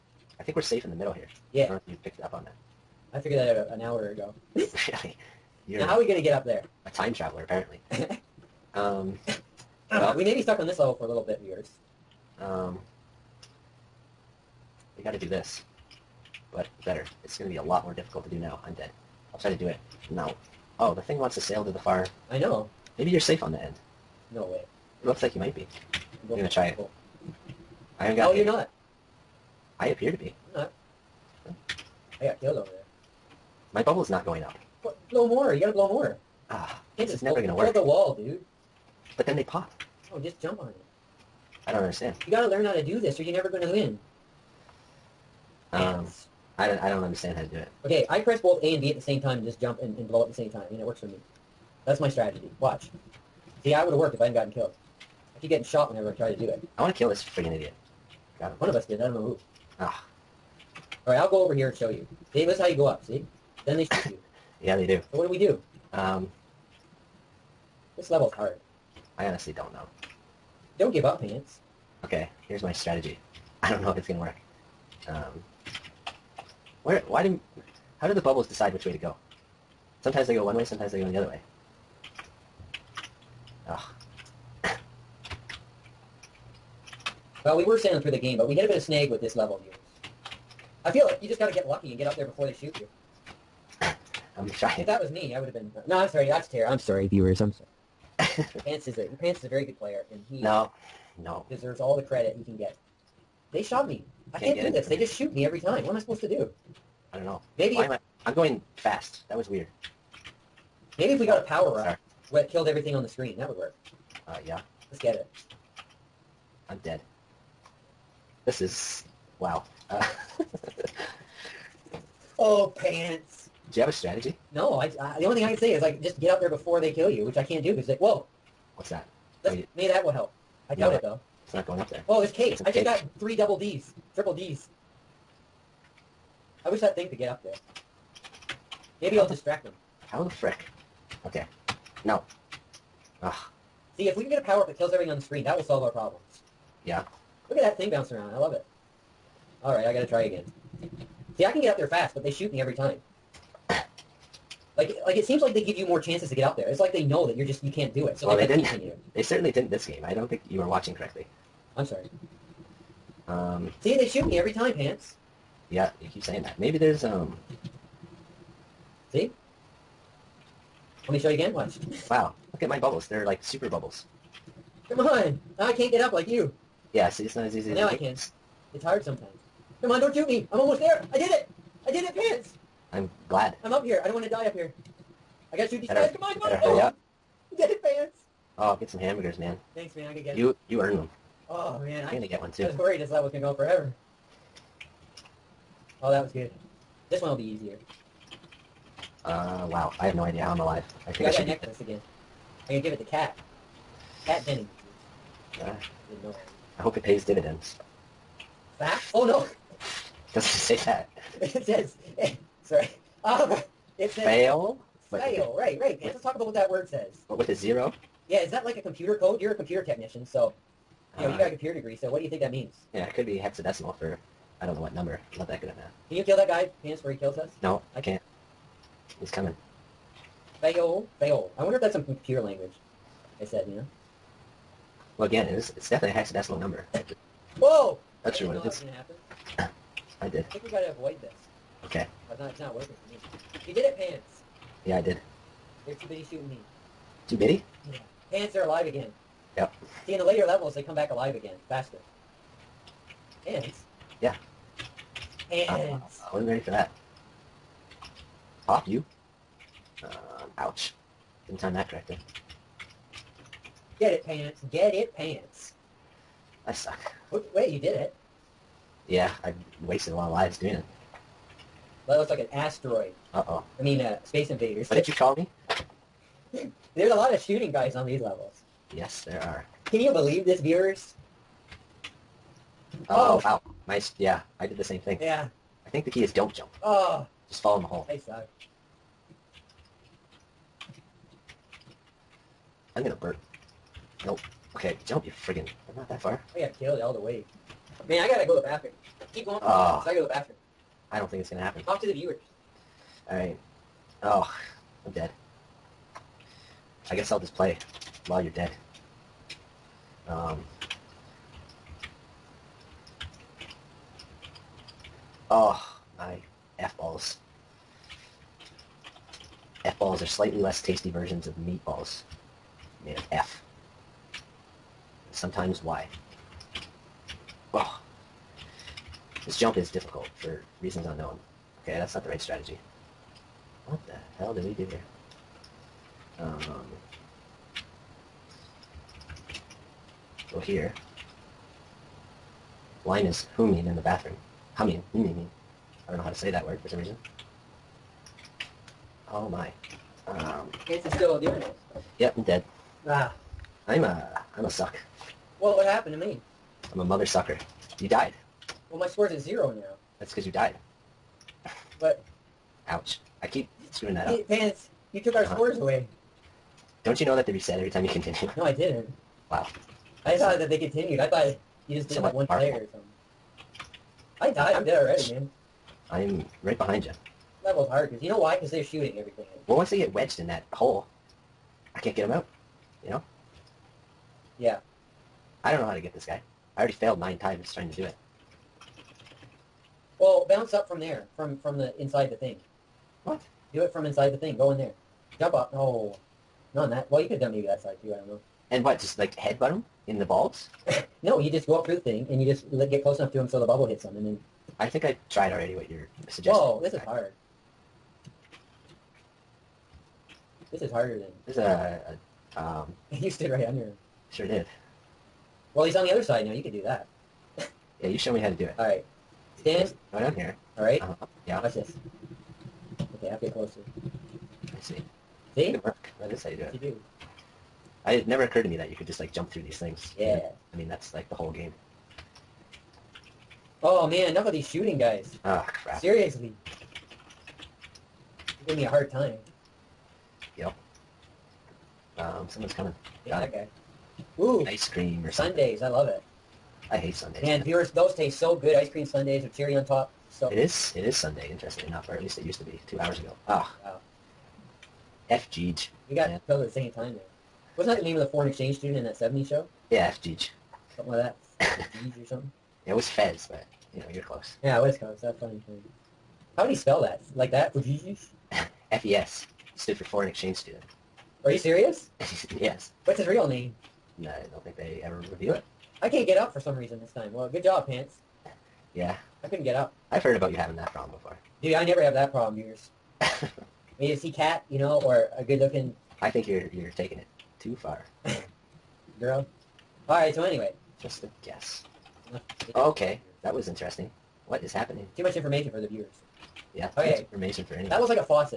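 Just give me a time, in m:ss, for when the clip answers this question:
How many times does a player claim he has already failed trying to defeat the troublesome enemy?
6:27.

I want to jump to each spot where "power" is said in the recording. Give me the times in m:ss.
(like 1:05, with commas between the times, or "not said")
1:51, 2:24.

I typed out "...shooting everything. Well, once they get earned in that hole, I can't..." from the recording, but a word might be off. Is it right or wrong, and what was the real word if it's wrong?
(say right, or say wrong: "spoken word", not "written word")
wrong: "wedged", not "earned".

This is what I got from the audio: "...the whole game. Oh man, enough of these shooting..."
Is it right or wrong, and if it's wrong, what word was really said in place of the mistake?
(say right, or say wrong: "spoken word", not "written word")
right.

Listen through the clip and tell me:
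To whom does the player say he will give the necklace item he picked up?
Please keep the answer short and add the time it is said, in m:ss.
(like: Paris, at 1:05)
Cat Denny, at 3:24.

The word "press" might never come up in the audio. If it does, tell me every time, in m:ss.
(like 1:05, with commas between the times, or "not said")
0:48.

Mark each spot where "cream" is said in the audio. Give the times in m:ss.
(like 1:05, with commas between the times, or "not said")
7:24, 7:28.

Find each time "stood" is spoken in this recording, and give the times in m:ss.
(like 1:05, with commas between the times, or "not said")
6:53, 7:49.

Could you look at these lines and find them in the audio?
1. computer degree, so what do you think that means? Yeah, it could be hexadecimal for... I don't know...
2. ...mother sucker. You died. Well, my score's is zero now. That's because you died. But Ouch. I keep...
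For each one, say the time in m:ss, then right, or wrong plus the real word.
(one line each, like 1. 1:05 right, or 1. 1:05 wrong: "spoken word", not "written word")
1. 3:41 right
2. 5:57 right.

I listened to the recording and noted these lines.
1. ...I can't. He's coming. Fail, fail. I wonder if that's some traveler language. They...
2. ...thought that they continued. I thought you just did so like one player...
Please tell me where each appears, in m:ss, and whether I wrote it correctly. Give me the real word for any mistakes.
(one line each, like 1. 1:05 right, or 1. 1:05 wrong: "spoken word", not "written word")
1. 3:47 wrong: "computer", not "traveler"
2. 6:10 right.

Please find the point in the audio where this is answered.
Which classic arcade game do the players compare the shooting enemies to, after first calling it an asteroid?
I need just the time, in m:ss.
4:34.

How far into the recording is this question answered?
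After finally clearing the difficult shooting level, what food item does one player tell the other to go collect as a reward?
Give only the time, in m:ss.
3:08.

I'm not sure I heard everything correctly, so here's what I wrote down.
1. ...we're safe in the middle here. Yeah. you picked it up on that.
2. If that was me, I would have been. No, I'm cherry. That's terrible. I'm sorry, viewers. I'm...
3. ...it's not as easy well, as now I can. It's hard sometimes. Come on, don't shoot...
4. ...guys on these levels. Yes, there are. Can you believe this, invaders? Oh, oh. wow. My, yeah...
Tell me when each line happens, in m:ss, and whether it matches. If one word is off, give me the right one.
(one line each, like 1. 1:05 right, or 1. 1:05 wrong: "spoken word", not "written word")
1. 0:00 right
2. 1:34 wrong: "sorry", not "cherry"
3. 2:57 right
4. 4:37 wrong: "viewers", not "invaders".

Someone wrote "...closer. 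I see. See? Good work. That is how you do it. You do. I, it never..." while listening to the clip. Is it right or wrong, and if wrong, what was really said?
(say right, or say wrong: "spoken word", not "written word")
right.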